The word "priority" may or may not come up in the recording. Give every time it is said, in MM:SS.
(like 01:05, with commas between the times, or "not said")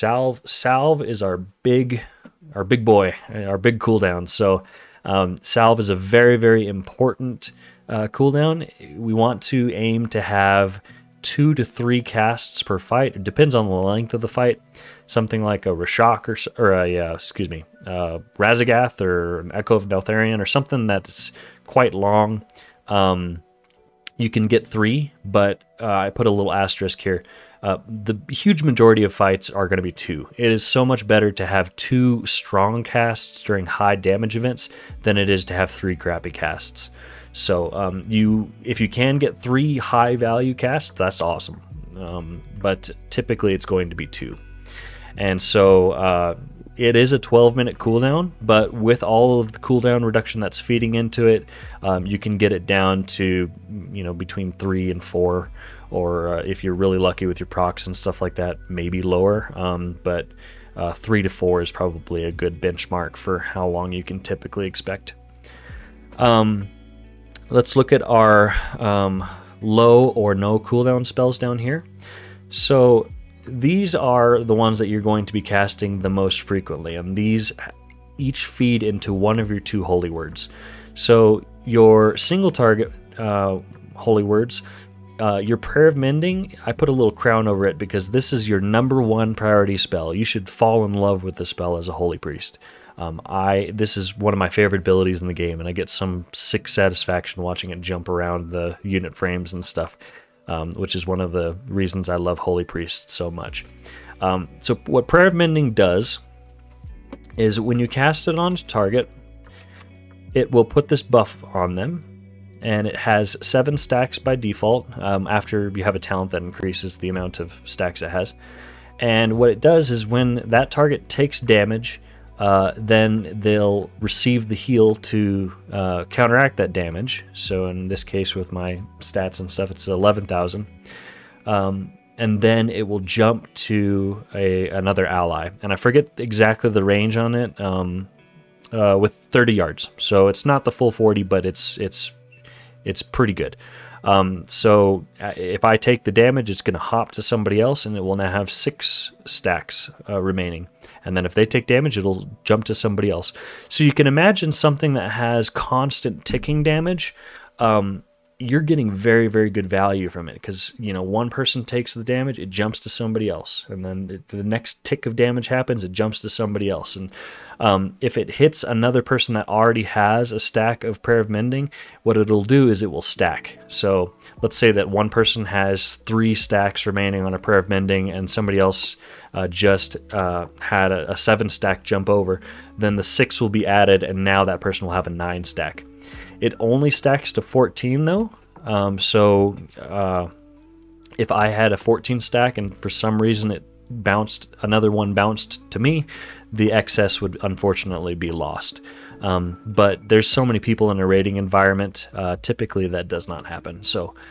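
01:29.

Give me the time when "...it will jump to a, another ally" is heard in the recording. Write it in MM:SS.
02:12.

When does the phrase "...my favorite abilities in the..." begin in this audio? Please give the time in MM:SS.
01:34.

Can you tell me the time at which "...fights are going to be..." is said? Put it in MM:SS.
00:29.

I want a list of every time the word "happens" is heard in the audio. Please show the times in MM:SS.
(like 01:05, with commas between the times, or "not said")
02:45, 03:23.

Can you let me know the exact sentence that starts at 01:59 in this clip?
And what it does is when that target takes damage, uh, then they'll receive the heal to uh, counteract that damage.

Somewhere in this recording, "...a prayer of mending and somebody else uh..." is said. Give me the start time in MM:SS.
02:57.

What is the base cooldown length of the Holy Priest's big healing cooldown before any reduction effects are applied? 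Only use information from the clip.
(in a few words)
12 minutes.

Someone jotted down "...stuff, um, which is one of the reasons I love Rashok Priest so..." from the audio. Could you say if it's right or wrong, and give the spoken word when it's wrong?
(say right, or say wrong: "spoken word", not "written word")
wrong: "Holy", not "Rashok".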